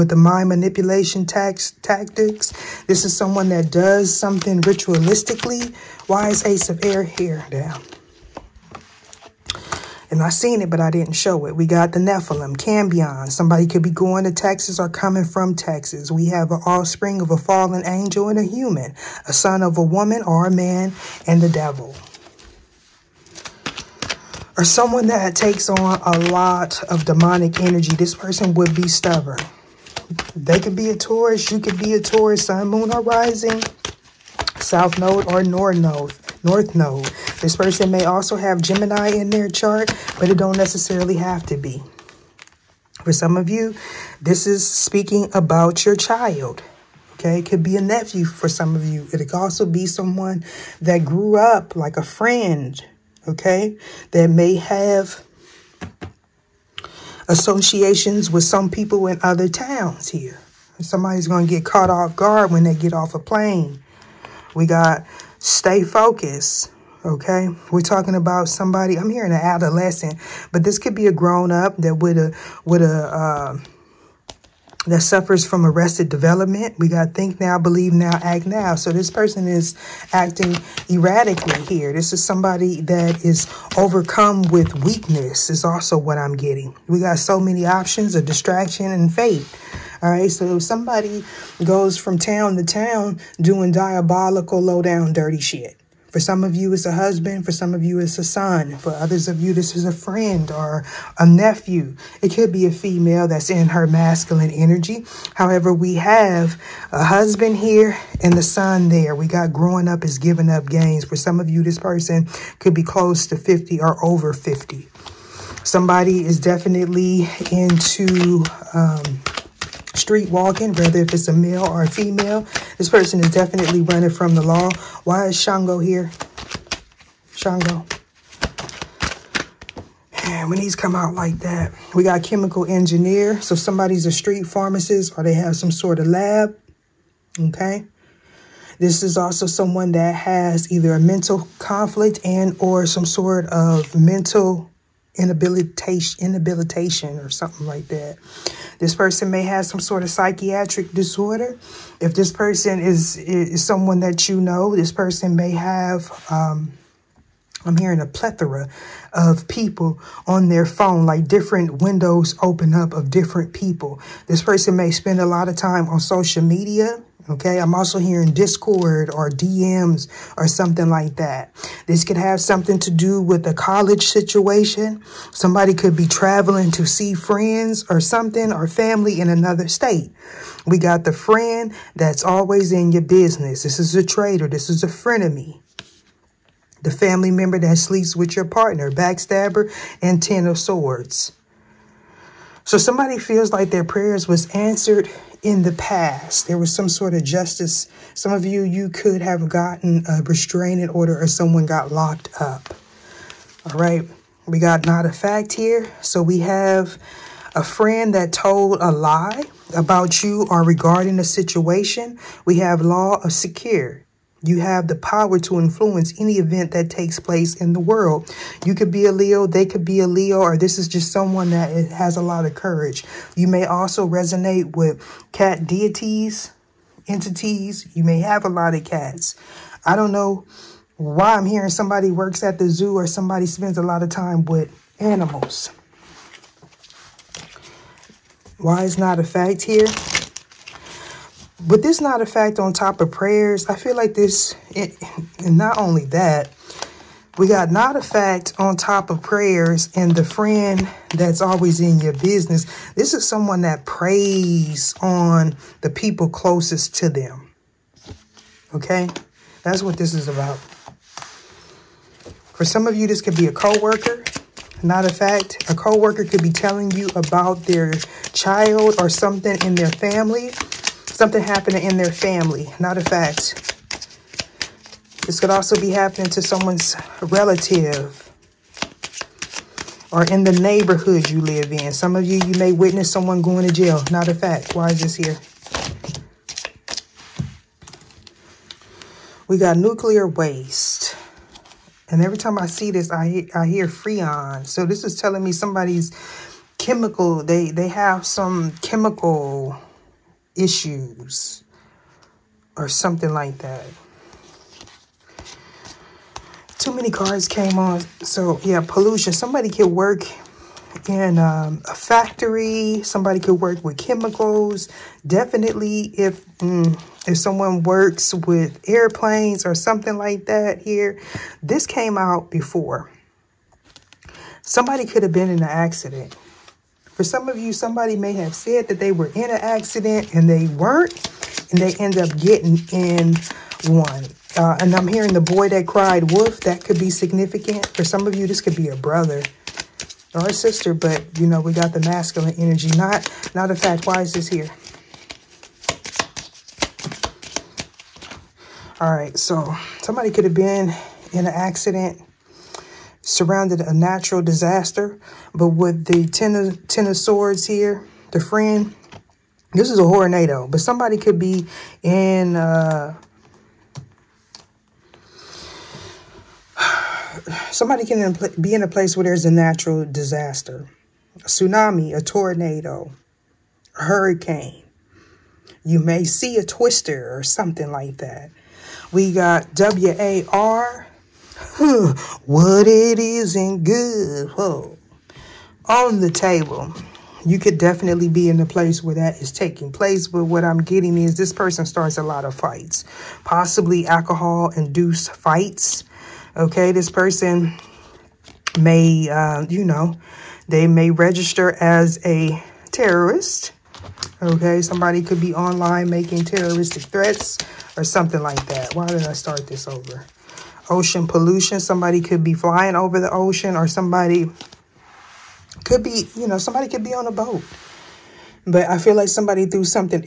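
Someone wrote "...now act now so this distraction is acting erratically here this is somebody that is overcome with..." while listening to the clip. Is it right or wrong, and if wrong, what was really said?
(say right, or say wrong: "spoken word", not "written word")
wrong: "person", not "distraction".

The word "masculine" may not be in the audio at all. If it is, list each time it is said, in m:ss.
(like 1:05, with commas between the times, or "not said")
1:43, 5:41.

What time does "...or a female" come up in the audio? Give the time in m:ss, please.
2:01.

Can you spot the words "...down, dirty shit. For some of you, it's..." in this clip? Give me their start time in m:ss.
1:34.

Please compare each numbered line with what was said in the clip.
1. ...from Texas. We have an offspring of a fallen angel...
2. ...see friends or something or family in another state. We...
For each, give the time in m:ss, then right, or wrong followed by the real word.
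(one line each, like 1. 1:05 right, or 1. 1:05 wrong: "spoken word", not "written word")
1. 0:15 right
2. 2:56 right.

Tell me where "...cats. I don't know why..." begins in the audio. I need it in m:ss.
3:48.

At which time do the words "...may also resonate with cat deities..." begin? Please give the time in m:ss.
3:43.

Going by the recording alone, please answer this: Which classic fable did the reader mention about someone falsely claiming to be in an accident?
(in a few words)
The boy that cried wolf.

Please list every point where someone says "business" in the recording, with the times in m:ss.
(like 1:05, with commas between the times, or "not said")
3:03, 4:12.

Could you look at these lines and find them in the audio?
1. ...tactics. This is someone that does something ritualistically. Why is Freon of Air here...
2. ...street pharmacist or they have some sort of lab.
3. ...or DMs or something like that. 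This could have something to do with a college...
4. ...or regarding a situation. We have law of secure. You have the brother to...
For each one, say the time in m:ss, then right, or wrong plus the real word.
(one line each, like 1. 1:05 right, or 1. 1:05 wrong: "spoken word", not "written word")
1. 0:01 wrong: "Ace", not "Freon"
2. 2:14 right
3. 2:49 right
4. 3:30 wrong: "power", not "brother".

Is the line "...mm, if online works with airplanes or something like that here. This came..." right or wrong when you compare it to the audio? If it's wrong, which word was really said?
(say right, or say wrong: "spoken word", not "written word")
wrong: "someone", not "online".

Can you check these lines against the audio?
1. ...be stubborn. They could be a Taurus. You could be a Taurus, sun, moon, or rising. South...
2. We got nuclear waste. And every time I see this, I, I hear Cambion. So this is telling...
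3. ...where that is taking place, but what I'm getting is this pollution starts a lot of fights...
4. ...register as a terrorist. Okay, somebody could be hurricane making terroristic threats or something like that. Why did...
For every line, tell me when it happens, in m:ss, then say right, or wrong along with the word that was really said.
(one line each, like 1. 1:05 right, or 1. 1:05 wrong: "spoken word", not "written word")
1. 0:28 right
2. 4:49 wrong: "Freon", not "Cambion"
3. 6:29 wrong: "person", not "pollution"
4. 6:41 wrong: "online", not "hurricane".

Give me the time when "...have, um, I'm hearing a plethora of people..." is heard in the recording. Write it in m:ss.
2:35.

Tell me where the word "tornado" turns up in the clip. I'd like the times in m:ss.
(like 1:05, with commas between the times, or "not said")
6:00, 6:12.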